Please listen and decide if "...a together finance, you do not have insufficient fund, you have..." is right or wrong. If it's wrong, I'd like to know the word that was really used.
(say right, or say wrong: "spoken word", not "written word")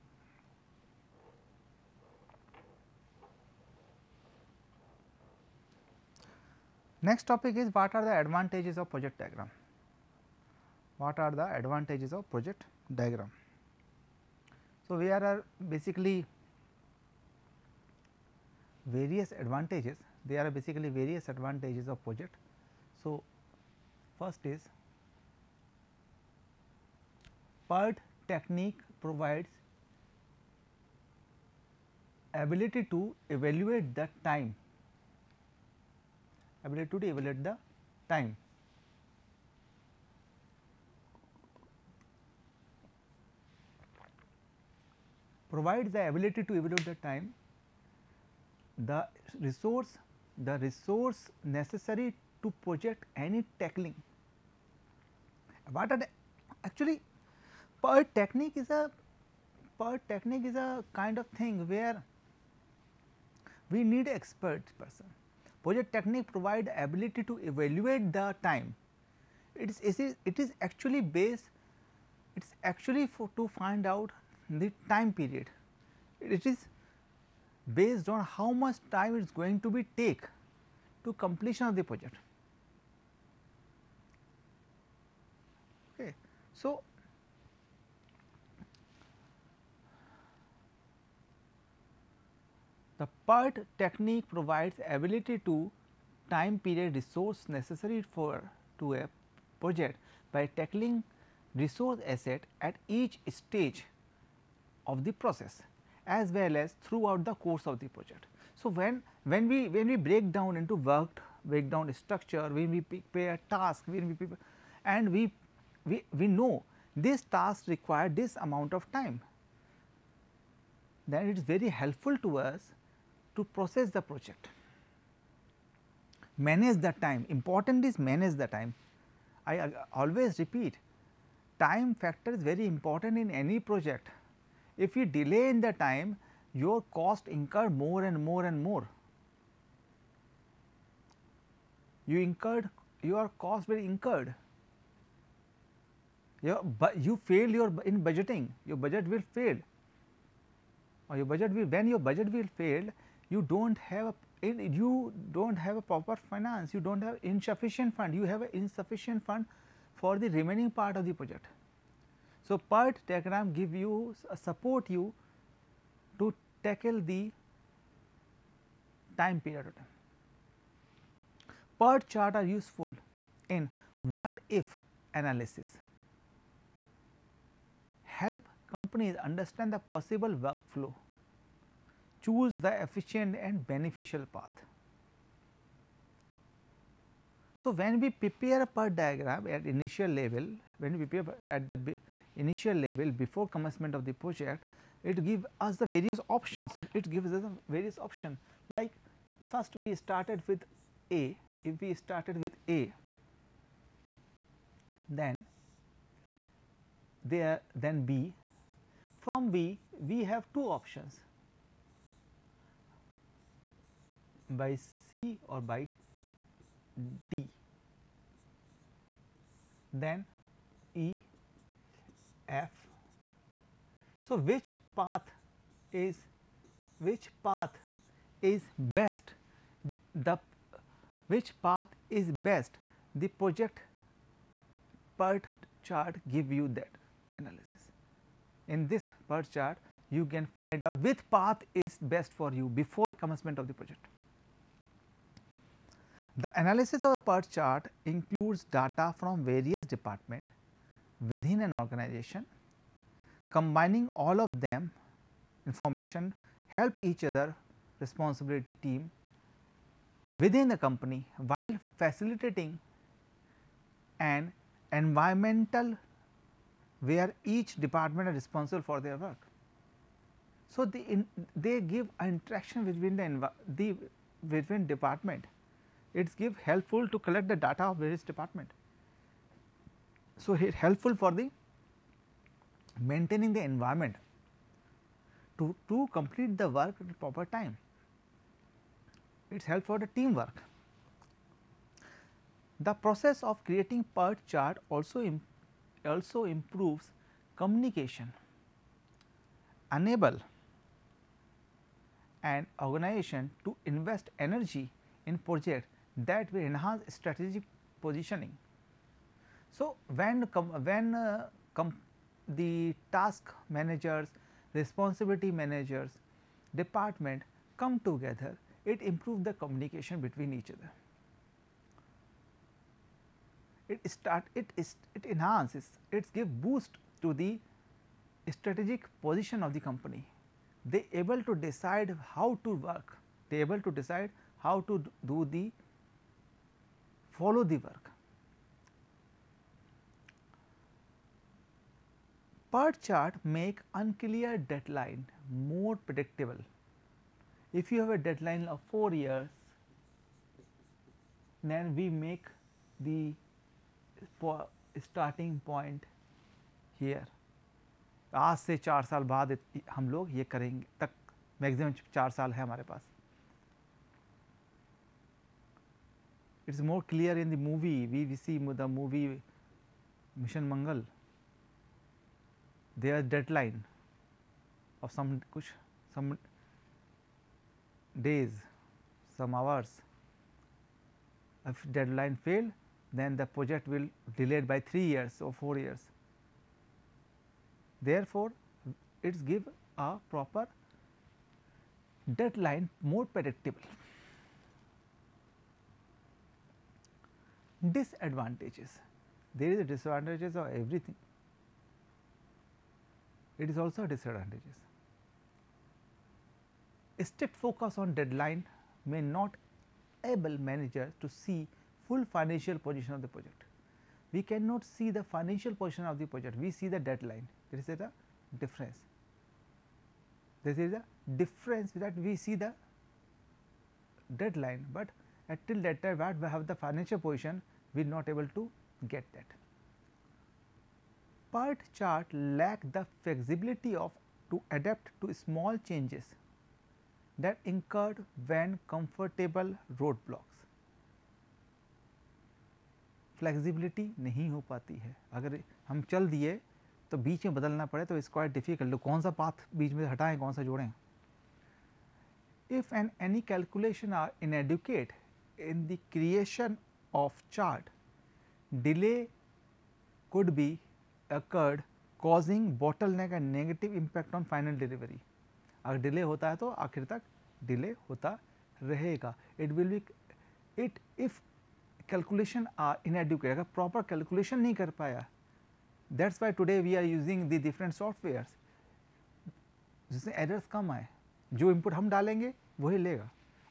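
wrong: "proper", not "together".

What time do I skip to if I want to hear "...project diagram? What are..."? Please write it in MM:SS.
00:08.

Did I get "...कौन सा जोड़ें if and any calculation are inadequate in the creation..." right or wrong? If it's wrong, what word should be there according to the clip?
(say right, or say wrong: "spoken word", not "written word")
right.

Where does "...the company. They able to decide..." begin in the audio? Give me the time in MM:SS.
05:29.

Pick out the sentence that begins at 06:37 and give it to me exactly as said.
Disadvantages, there is a disadvantages of everything it is also disadvantages.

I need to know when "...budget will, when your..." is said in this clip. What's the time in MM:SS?
02:31.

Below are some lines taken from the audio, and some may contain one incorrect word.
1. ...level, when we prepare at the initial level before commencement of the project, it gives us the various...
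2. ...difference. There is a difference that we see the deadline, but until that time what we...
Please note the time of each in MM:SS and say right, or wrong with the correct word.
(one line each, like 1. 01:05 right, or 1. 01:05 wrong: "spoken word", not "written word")
1. 03:10 right
2. 06:58 right.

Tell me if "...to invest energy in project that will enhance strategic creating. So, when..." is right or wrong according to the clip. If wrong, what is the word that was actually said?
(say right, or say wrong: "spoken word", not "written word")
wrong: "positioning", not "creating".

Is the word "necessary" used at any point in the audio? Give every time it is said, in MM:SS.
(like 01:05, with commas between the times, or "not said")
00:51, 01:37.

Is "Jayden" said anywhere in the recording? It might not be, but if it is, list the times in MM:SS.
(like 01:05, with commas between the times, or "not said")
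not said.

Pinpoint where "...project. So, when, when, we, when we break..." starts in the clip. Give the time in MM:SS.
01:47.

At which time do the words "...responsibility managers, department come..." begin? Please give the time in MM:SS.
05:14.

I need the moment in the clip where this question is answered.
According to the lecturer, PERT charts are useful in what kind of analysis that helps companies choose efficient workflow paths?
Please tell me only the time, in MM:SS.
02:54.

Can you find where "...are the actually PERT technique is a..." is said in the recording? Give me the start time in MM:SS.
00:55.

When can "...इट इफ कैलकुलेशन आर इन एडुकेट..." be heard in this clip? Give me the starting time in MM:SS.
07:50.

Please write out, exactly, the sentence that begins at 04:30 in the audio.
So, the in, they give interaction between the, the between department, it is give helpful to collect the data of various department.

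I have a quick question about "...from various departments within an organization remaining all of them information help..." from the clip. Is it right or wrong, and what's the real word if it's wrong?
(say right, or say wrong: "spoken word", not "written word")
wrong: "combining", not "remaining".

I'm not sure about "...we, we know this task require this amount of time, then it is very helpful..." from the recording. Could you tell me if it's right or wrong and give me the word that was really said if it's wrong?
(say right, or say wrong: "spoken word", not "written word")
right.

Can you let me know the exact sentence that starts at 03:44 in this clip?
So, which path is which path is best the which path is best the project PERT chart give you that analysis.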